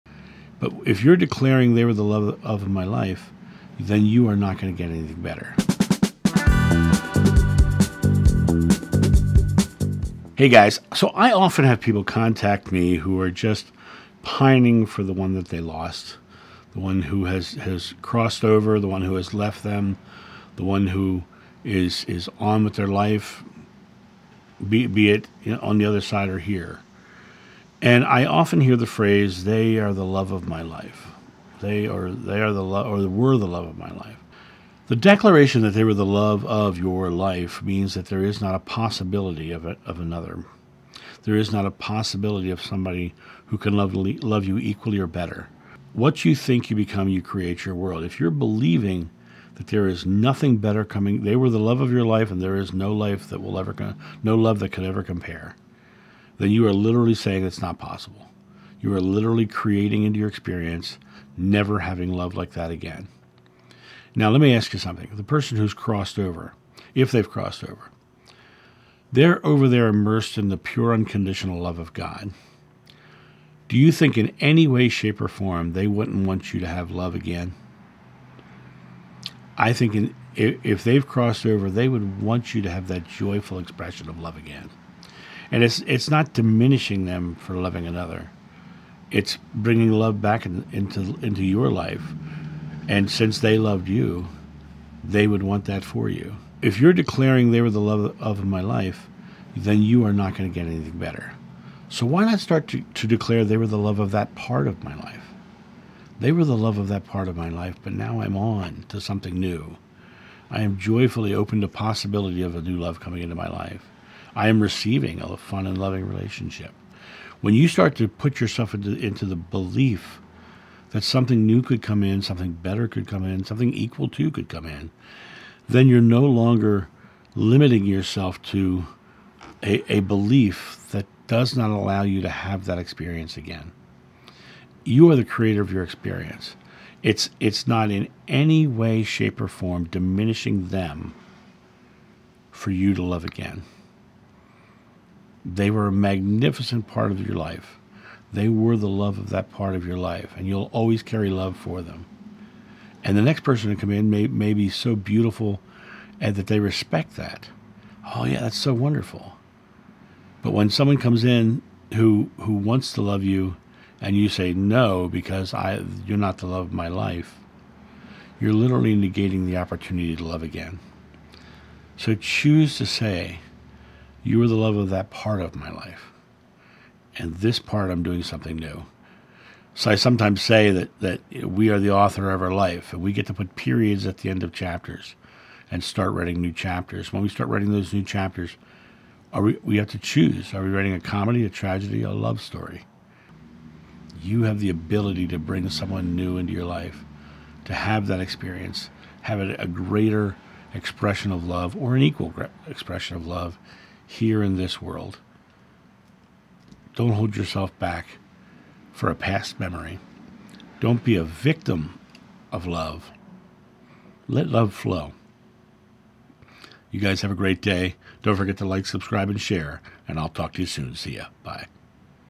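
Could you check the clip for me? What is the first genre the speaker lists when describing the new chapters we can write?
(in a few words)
Comedy.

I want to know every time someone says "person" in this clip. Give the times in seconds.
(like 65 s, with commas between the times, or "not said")
65 s, 153 s.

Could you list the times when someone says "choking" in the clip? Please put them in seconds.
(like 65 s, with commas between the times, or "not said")
not said.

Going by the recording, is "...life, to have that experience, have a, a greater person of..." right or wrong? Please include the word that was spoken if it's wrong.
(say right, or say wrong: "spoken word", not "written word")
wrong: "expression", not "person".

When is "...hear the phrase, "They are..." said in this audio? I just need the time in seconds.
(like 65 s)
28 s.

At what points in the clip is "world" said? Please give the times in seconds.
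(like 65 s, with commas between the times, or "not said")
47 s, 204 s.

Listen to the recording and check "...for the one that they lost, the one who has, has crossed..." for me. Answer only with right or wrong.
right.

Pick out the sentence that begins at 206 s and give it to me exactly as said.
Don't hold yourself back for a past memory.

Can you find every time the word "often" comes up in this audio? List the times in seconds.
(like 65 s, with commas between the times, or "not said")
11 s, 28 s.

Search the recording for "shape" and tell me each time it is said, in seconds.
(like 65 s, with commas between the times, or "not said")
74 s, 139 s.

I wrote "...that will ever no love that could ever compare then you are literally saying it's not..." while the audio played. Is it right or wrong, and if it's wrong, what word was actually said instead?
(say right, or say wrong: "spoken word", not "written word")
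right.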